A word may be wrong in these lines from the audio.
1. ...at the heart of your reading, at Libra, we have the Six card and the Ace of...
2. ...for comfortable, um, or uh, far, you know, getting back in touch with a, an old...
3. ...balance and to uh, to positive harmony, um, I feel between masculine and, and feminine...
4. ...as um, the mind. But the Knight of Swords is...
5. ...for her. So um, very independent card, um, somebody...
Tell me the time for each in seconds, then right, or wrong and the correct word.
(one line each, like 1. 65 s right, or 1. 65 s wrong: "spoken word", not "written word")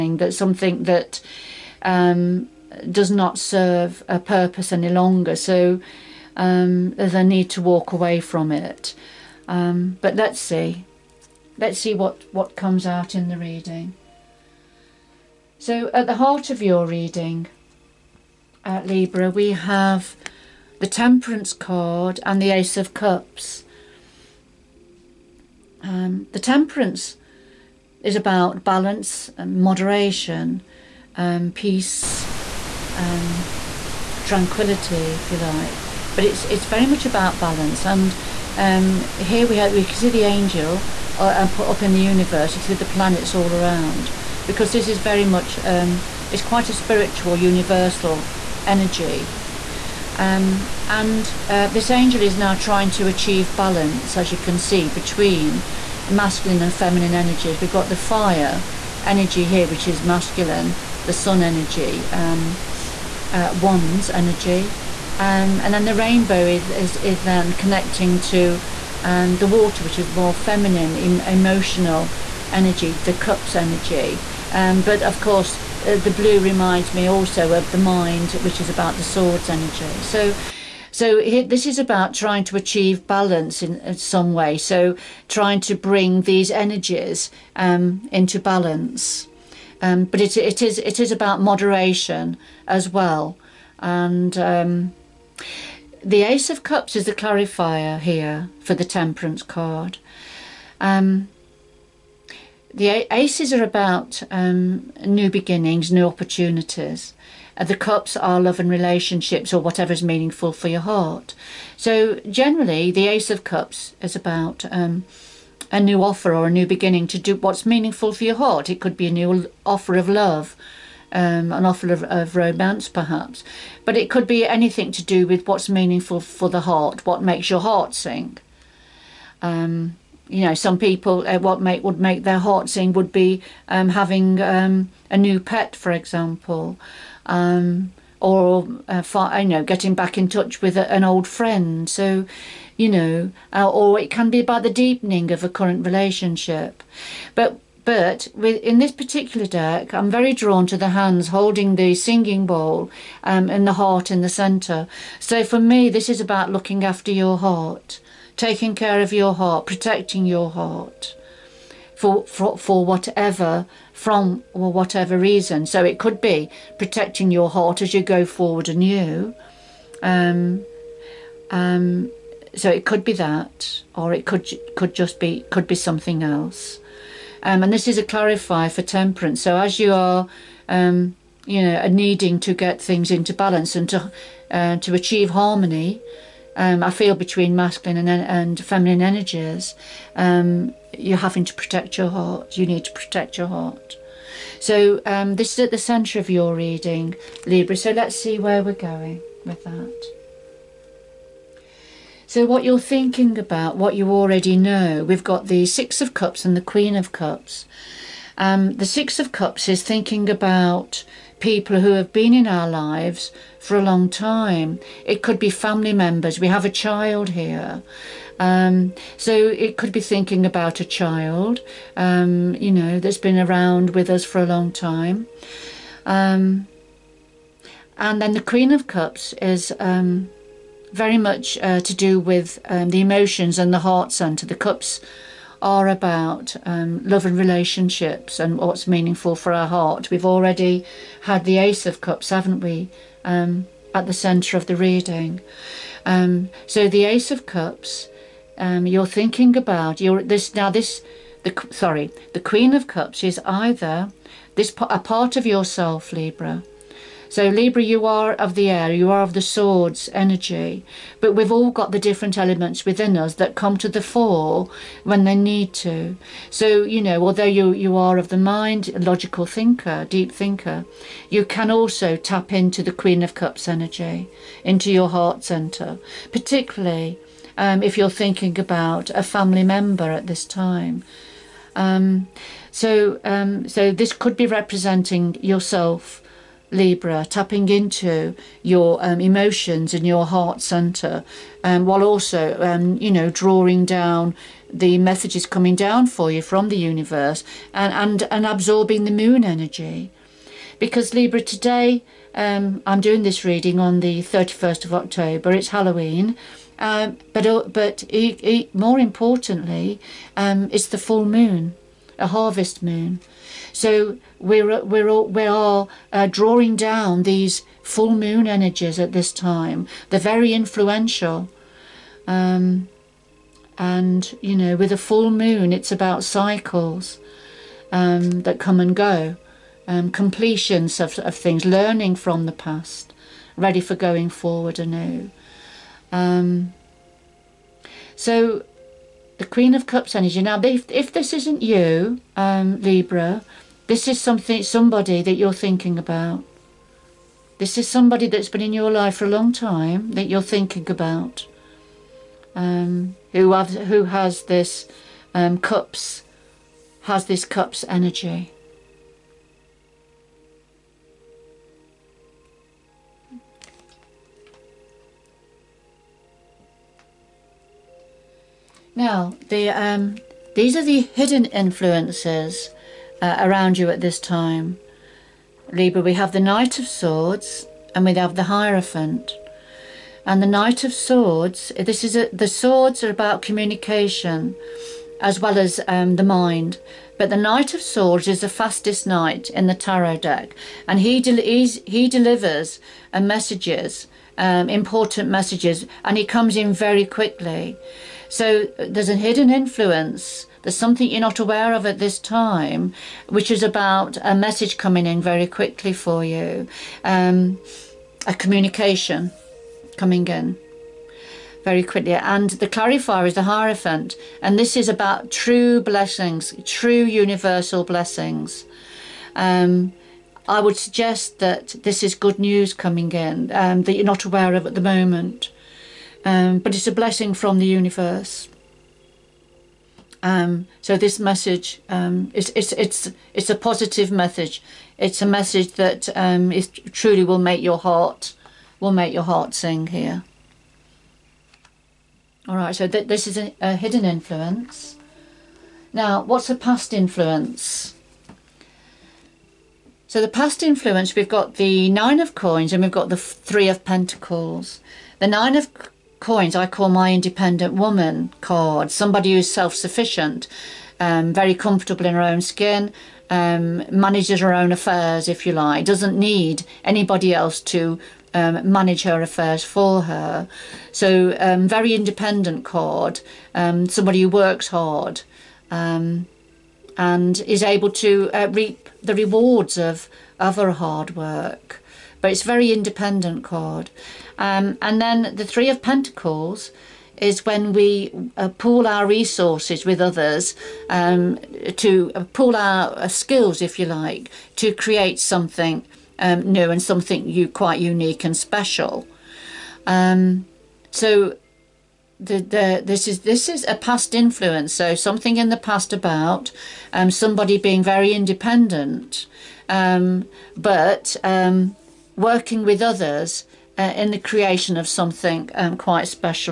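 1. 15 s wrong: "Temperance", not "Six"
2. 135 s wrong: "example", not "comfortable"
3. 183 s wrong: "achieve", not "positive"
4. 385 s right
5. 469 s right.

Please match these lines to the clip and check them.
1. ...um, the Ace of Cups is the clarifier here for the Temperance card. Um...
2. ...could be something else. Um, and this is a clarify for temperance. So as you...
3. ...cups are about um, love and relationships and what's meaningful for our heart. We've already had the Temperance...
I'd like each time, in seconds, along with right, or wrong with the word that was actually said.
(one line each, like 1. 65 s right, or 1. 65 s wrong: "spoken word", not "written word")
1. 94 s right
2. 175 s right
3. 234 s wrong: "Ace", not "Temperance".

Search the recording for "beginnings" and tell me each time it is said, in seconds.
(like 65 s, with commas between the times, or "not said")
105 s, 116 s.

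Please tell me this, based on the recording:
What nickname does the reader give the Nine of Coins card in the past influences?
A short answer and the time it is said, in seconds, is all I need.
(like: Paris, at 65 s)
Independent woman card, at 457 s.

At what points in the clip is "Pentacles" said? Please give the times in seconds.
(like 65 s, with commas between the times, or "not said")
453 s, 485 s.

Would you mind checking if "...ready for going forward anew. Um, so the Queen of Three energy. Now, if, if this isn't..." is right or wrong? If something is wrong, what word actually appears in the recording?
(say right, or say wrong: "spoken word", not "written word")
wrong: "Cups", not "Three".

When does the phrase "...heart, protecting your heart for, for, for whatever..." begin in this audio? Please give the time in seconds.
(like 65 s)
159 s.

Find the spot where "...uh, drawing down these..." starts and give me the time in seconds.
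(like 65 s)
316 s.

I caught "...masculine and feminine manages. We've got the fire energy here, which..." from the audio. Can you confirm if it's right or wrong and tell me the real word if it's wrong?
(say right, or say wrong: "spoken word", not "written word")
wrong: "energies", not "manages".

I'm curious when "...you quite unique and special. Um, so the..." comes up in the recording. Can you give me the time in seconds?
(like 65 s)
497 s.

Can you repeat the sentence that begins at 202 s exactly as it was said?
So, what you're thinking about, what you already know, we've got the Six of Cups and the Queen of Cups.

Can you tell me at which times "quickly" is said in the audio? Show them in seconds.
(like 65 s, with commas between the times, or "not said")
397 s, 405 s, 411 s.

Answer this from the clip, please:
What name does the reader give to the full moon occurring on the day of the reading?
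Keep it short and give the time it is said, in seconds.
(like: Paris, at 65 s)
Harvest moon, at 312 s.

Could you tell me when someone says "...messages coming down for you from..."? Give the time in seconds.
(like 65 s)
294 s.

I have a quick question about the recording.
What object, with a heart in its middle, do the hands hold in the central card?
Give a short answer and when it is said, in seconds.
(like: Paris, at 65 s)
Singing bowl, at 151 s.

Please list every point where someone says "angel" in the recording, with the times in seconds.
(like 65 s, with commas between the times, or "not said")
40 s, 51 s.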